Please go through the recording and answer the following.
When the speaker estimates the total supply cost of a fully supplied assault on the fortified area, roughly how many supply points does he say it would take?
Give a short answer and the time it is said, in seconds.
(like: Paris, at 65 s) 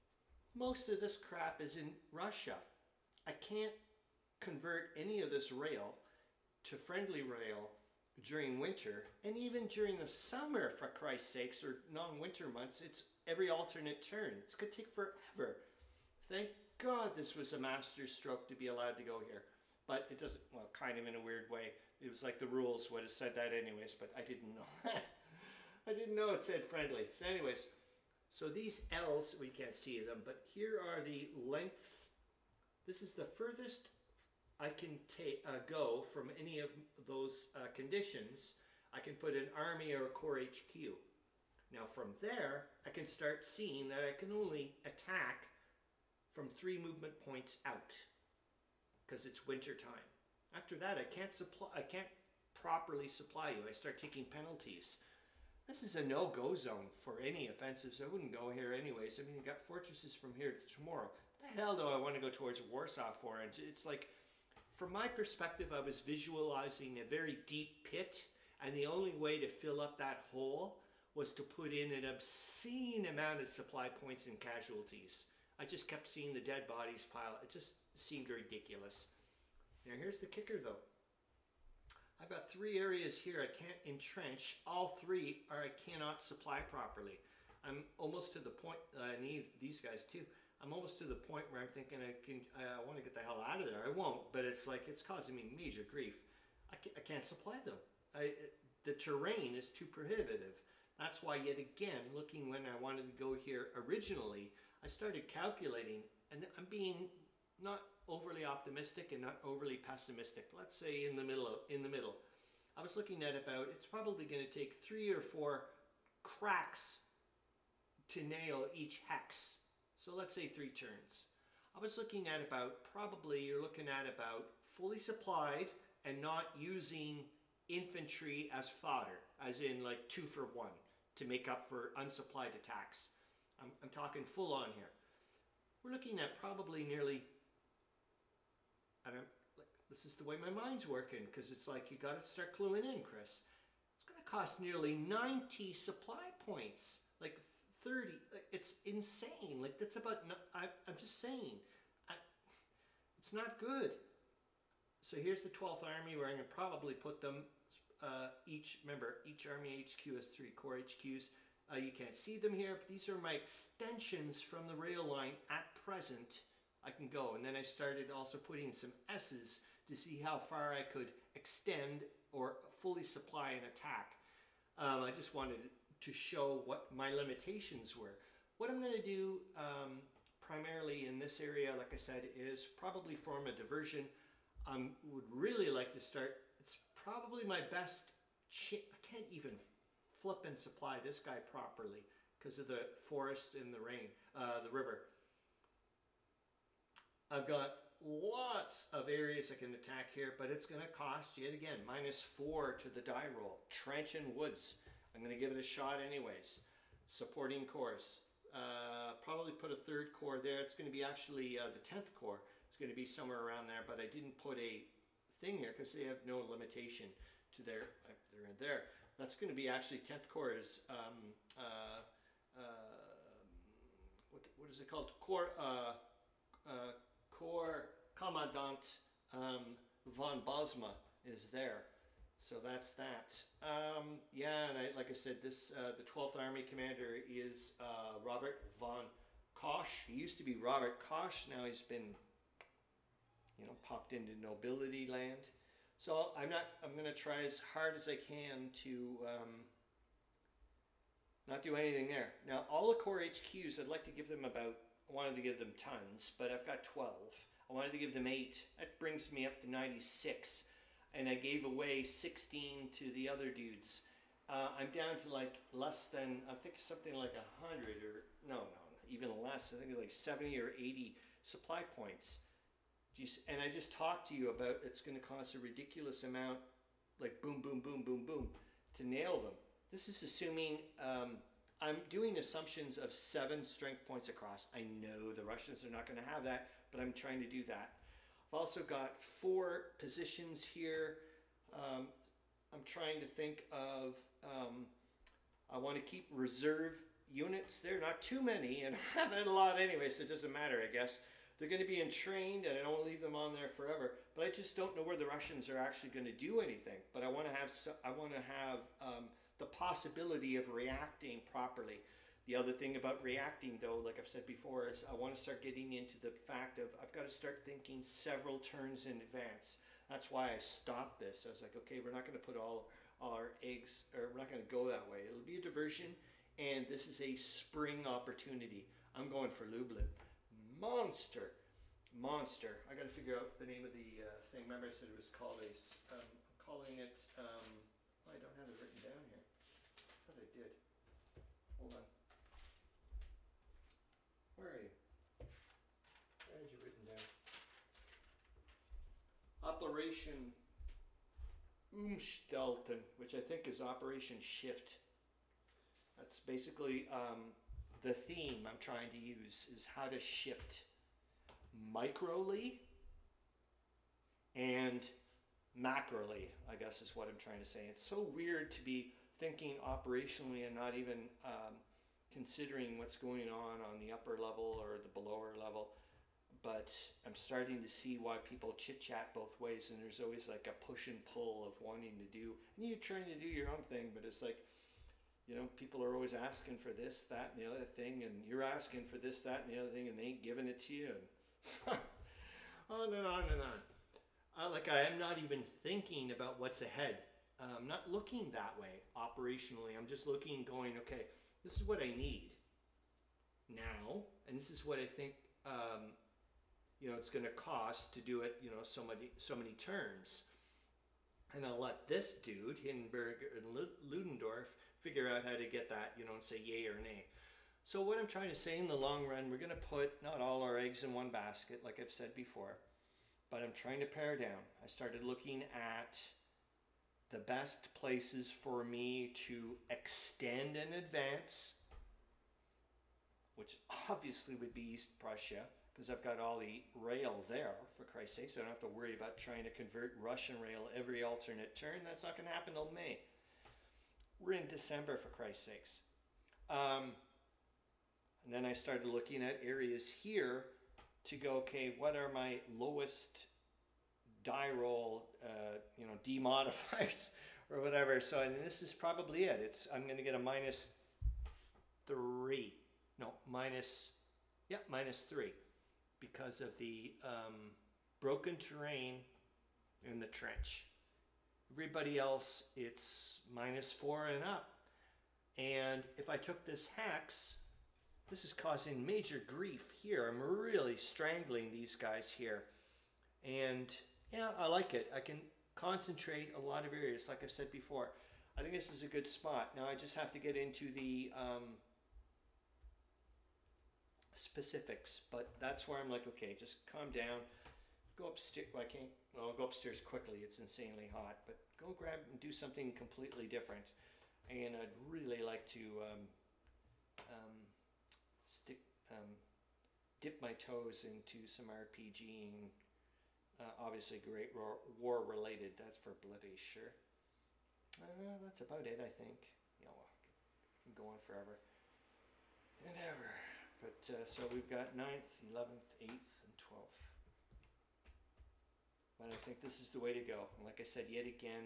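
90, at 145 s.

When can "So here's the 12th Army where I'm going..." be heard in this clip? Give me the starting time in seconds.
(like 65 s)
155 s.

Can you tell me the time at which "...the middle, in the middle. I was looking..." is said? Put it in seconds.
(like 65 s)
111 s.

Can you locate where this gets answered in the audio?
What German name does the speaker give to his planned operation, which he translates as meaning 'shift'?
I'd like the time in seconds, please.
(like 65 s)
349 s.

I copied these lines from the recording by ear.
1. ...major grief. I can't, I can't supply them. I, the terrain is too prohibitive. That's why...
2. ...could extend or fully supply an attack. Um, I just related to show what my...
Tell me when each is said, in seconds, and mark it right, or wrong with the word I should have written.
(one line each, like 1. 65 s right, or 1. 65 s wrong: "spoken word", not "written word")
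1. 95 s right
2. 170 s wrong: "wanted", not "related".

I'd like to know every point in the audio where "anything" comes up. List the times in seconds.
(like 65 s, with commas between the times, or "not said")
251 s, 306 s.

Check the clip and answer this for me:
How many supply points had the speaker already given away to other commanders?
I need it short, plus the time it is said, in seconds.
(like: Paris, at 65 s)
16, at 262 s.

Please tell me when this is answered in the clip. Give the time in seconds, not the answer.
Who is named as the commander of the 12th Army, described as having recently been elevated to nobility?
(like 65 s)
238 s.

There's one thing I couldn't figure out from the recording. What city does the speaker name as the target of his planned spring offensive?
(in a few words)
Lublin.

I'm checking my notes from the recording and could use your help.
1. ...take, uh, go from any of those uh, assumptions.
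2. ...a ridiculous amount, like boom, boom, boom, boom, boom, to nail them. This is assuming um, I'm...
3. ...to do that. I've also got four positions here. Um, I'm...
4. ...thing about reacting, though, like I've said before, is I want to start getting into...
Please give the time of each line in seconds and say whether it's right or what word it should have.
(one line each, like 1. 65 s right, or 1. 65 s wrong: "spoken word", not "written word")
1. 35 s wrong: "conditions", not "assumptions"
2. 275 s right
3. 287 s right
4. 312 s right.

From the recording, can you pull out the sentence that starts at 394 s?
Uh, like I am not even thinking about what's ahead.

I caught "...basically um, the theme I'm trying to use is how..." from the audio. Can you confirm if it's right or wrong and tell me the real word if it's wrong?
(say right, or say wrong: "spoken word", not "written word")
right.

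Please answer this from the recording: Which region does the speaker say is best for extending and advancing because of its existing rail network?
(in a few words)
East Prussia.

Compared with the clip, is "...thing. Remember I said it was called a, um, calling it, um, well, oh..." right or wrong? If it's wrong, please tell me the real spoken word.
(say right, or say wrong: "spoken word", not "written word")
right.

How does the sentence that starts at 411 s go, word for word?
And I'll let this dude, Hindenburg and Ludendorff, figure out how to get that, you know, and say yay or nay.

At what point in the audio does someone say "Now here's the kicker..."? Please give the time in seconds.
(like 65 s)
79 s.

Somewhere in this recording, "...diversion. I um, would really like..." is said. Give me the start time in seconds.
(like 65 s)
183 s.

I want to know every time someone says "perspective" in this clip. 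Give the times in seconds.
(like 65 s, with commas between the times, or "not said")
65 s.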